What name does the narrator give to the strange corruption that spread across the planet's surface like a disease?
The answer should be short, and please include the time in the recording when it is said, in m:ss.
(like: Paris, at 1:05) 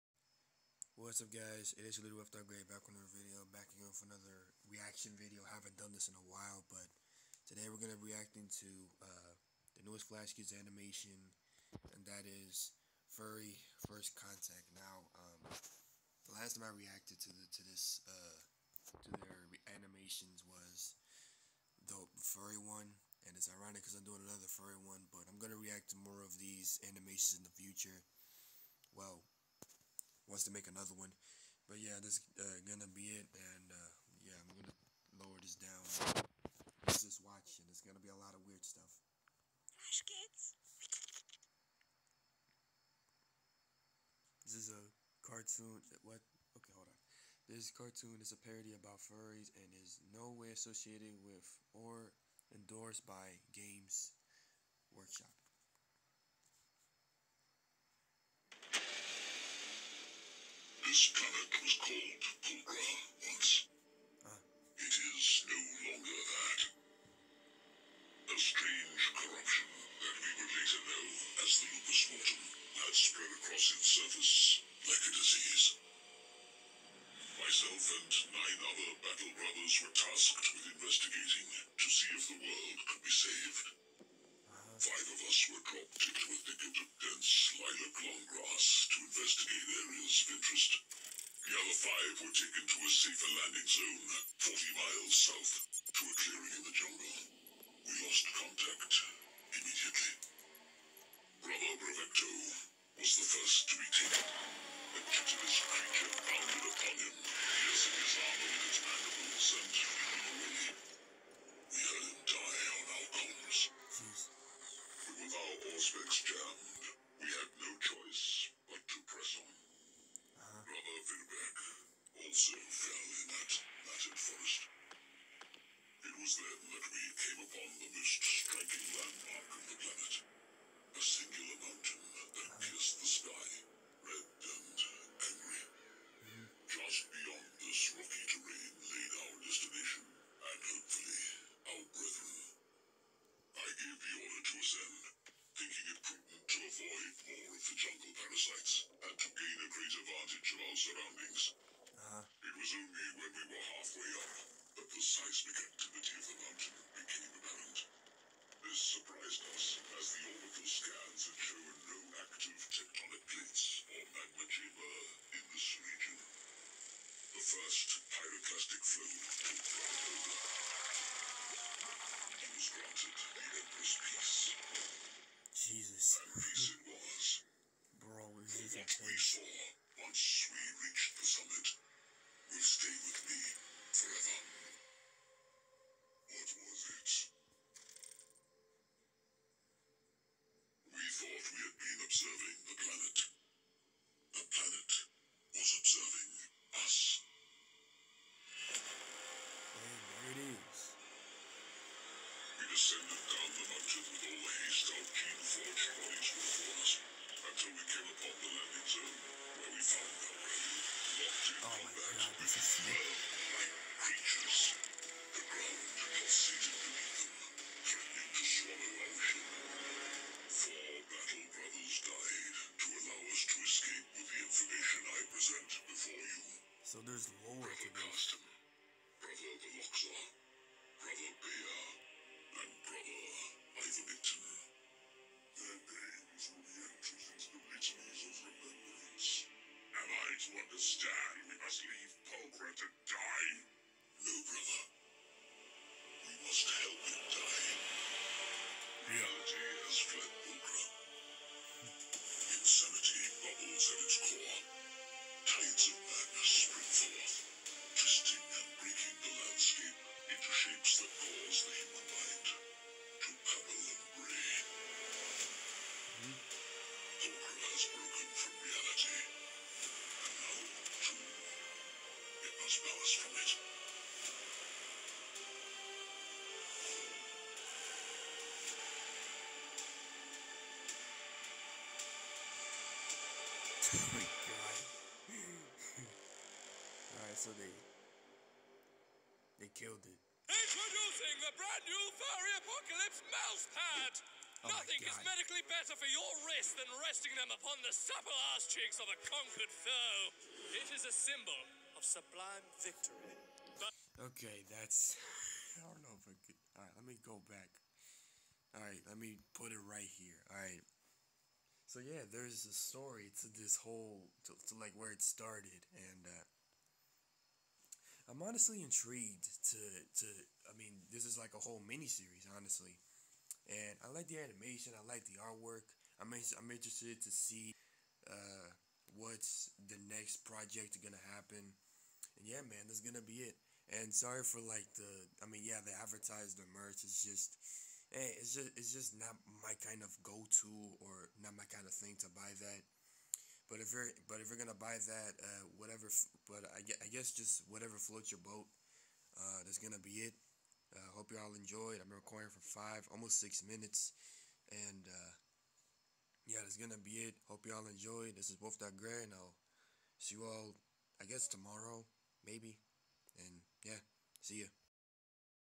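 lupus mortem, at 1:11.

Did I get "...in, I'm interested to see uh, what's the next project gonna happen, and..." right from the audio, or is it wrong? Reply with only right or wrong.
right.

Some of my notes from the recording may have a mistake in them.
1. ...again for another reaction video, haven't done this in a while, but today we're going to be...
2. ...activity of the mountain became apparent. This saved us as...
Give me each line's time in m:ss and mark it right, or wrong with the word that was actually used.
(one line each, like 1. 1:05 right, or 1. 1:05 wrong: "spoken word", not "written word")
1. 0:03 right
2. 2:35 wrong: "surprised", not "saved".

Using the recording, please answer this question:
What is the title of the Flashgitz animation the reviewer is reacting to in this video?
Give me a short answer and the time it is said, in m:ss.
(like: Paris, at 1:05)
Furry First Contact, at 0:13.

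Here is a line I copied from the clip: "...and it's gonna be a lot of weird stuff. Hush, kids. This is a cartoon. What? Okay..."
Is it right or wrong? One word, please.
right.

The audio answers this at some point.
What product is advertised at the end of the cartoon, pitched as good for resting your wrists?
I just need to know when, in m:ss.
4:52.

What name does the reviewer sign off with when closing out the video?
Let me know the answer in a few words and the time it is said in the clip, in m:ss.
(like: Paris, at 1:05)
Wolf Dog Grey, at 5:58.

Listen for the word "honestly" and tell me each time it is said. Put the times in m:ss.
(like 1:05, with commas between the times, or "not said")
5:18, 5:22.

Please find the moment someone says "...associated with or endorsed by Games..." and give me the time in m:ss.
0:50.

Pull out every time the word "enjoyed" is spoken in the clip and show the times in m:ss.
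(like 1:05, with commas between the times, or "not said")
5:51, 5:57.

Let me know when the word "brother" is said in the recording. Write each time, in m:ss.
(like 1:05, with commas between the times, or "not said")
1:19, 1:41, 2:00, 4:04.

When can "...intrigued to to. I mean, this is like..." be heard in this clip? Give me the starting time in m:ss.
5:18.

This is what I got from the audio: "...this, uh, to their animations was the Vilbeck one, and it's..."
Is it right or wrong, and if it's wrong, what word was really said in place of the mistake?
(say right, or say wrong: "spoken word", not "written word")
wrong: "Furry", not "Vilbeck".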